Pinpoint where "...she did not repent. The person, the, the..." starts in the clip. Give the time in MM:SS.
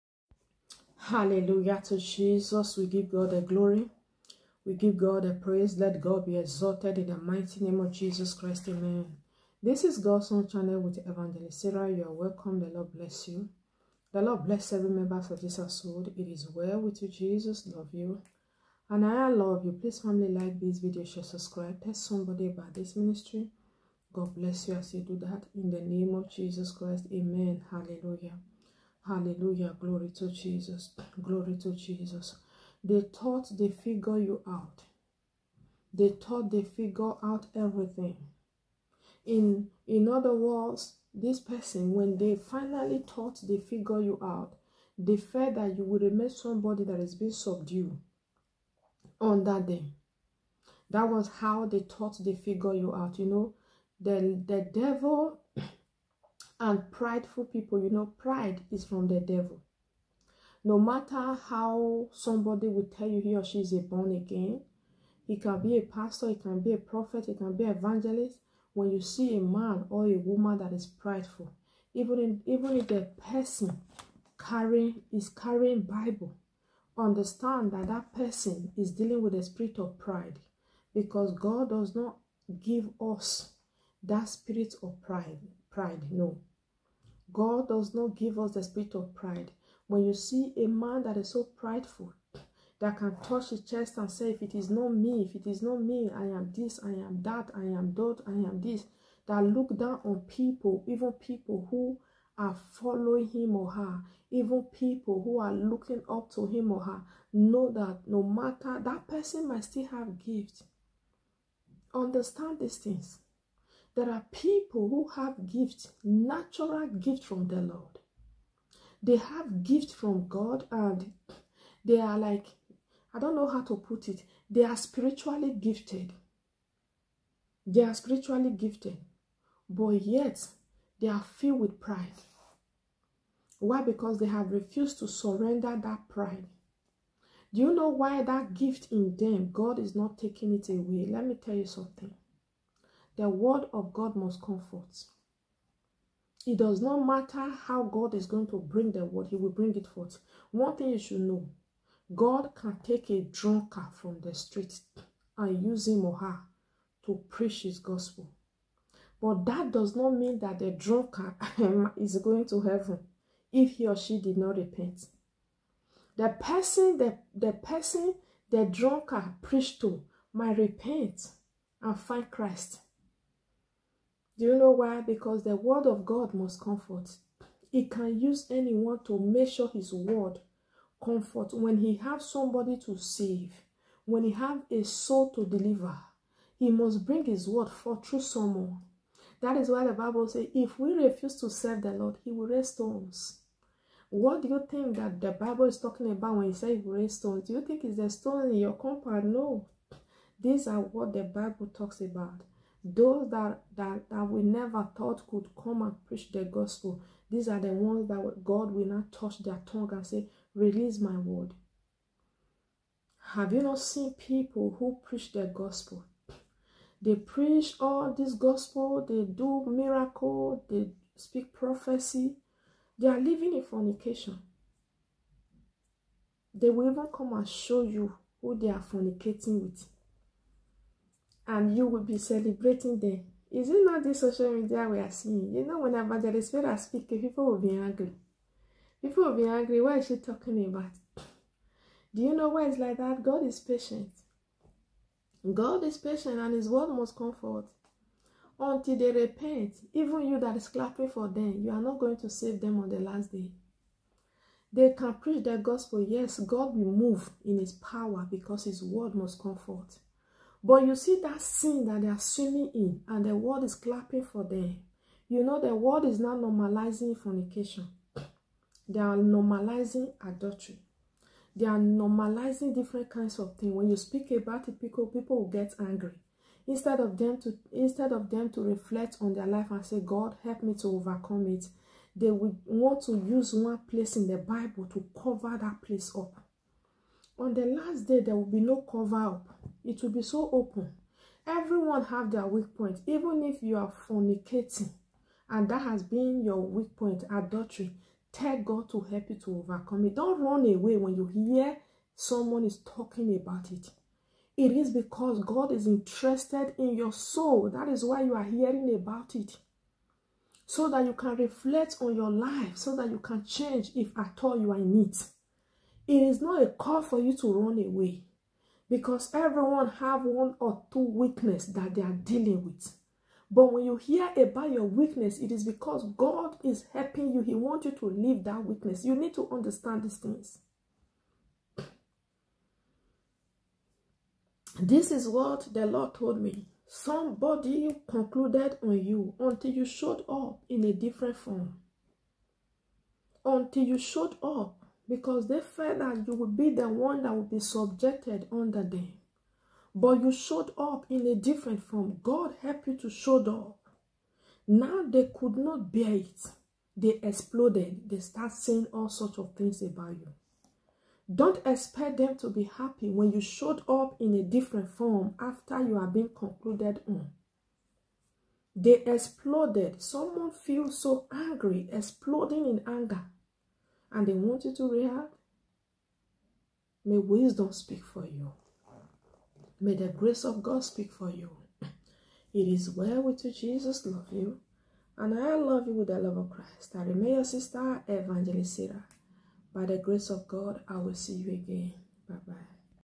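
02:43.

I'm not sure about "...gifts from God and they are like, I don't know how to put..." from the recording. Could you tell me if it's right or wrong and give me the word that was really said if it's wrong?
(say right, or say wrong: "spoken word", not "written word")
right.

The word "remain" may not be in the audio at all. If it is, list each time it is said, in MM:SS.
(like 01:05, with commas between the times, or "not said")
00:45, 06:27.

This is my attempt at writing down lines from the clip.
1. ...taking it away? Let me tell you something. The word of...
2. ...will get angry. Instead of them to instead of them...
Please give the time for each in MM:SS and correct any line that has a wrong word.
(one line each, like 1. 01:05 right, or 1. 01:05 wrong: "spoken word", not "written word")
1. 02:20 right
2. 04:35 right.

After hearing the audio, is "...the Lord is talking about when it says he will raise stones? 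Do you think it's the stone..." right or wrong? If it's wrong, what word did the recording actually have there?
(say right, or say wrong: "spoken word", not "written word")
wrong: "Bible", not "Lord".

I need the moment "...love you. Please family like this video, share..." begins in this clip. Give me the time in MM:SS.
00:19.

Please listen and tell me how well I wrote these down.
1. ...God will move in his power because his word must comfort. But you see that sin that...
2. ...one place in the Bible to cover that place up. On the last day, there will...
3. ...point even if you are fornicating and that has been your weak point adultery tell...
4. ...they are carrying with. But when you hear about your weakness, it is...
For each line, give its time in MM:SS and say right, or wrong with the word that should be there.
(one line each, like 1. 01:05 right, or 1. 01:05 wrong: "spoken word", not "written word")
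1. 04:16 right
2. 04:43 right
3. 04:52 right
4. 05:21 wrong: "dealing", not "carrying".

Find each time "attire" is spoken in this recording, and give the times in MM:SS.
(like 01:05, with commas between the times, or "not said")
not said.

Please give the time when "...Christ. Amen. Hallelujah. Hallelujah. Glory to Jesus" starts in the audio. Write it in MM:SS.
00:26.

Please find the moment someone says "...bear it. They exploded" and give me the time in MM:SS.
05:55.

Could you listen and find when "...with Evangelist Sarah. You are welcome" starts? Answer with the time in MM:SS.
00:10.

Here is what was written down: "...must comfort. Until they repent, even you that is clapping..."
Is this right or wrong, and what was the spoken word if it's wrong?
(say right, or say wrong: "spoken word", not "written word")
right.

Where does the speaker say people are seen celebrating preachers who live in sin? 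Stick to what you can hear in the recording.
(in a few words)
Social media.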